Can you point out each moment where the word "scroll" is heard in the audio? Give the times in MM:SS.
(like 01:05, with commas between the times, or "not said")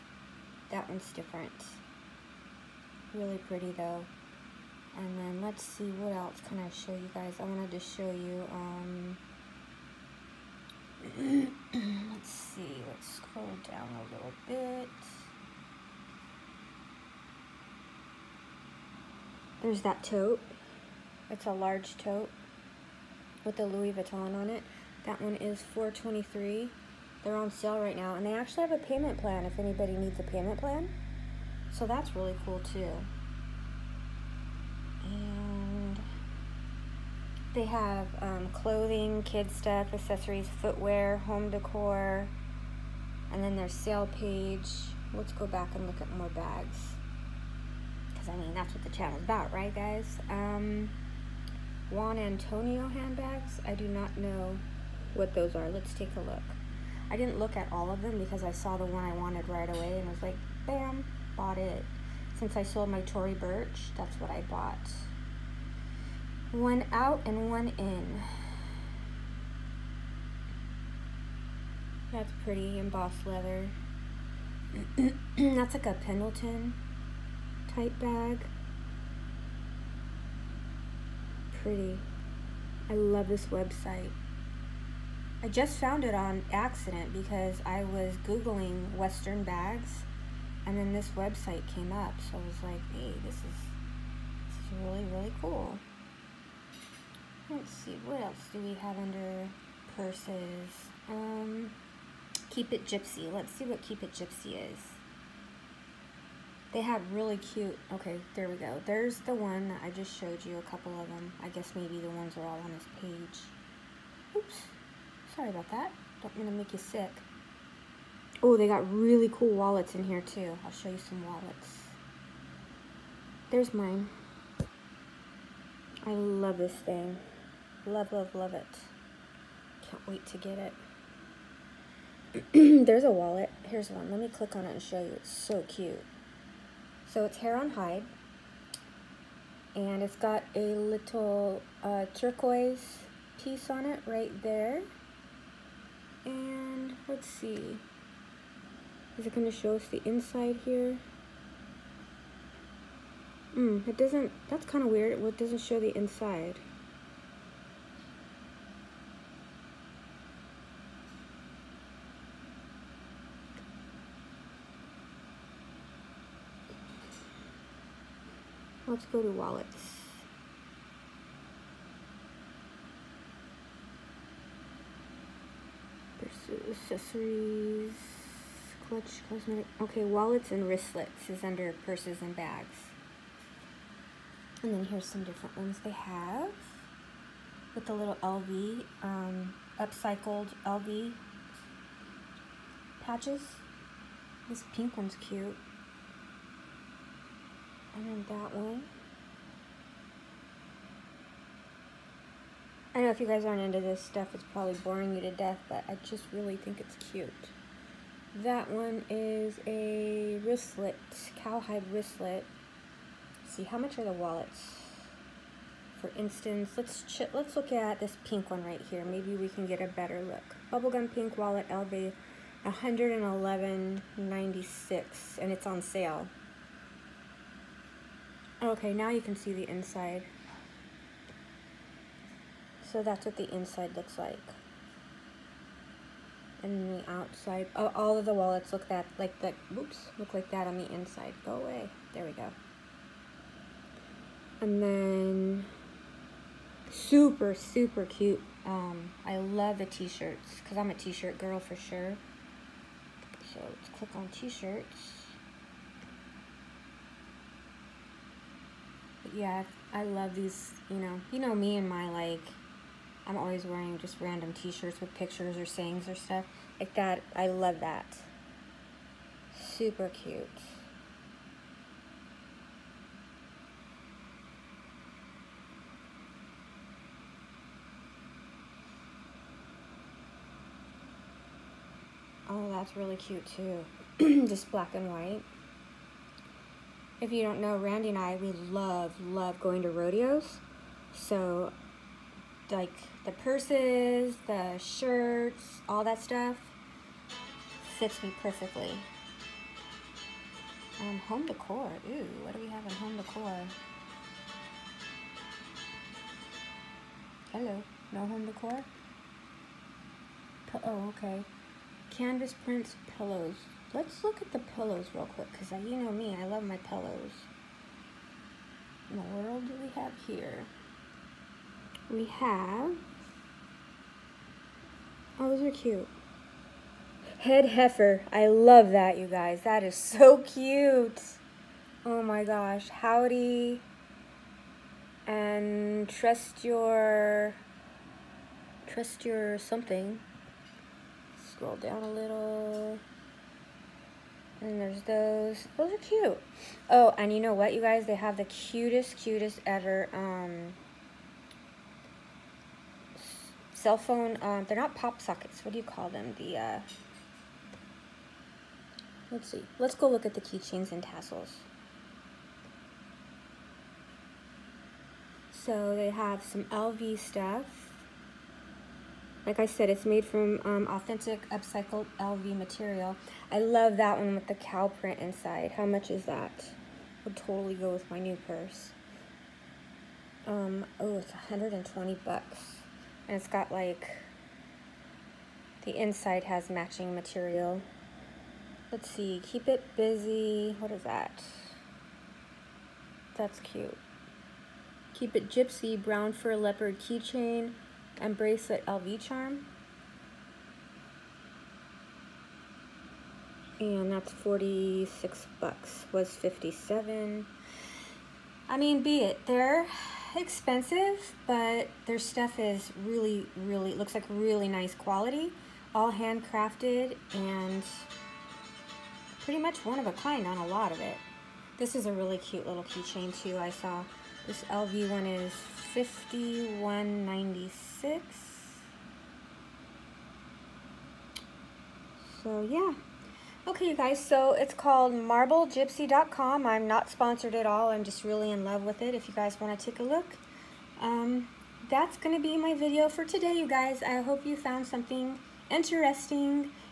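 00:13, 05:41.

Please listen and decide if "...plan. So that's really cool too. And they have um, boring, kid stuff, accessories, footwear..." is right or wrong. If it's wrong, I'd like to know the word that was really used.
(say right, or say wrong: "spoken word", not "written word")
wrong: "clothing", not "boring".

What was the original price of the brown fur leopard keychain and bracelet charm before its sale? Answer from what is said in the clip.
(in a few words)
57.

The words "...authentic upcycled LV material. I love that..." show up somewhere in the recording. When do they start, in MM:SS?
06:10.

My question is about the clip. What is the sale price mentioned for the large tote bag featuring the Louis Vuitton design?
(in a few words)
423.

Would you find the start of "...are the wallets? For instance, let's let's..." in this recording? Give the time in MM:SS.
03:33.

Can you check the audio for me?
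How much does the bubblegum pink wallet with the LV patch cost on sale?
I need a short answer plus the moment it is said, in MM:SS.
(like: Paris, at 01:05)
111.96, at 03:42.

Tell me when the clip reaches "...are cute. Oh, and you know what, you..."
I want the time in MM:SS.
05:45.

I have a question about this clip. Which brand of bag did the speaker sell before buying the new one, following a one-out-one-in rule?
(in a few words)
Tory Burch.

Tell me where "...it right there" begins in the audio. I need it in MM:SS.
02:23.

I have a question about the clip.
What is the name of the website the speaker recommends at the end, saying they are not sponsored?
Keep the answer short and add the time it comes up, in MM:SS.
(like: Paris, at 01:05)
marblegypsy.com, at 07:15.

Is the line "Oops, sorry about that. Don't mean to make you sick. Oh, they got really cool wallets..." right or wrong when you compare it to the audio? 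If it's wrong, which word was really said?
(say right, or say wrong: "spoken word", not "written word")
right.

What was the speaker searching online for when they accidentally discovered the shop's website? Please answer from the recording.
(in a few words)
Western bags.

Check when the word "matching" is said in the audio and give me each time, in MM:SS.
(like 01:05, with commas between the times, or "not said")
06:26.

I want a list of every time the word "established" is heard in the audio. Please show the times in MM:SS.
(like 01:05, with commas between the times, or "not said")
not said.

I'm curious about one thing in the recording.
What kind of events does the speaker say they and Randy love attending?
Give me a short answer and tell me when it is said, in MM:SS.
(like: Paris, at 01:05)
Rodeos, at 04:49.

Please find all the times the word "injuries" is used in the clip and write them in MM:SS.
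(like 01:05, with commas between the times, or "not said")
not said.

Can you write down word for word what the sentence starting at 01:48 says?
There's the one that I just showed you, a couple of them.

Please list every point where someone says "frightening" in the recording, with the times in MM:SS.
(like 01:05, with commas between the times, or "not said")
not said.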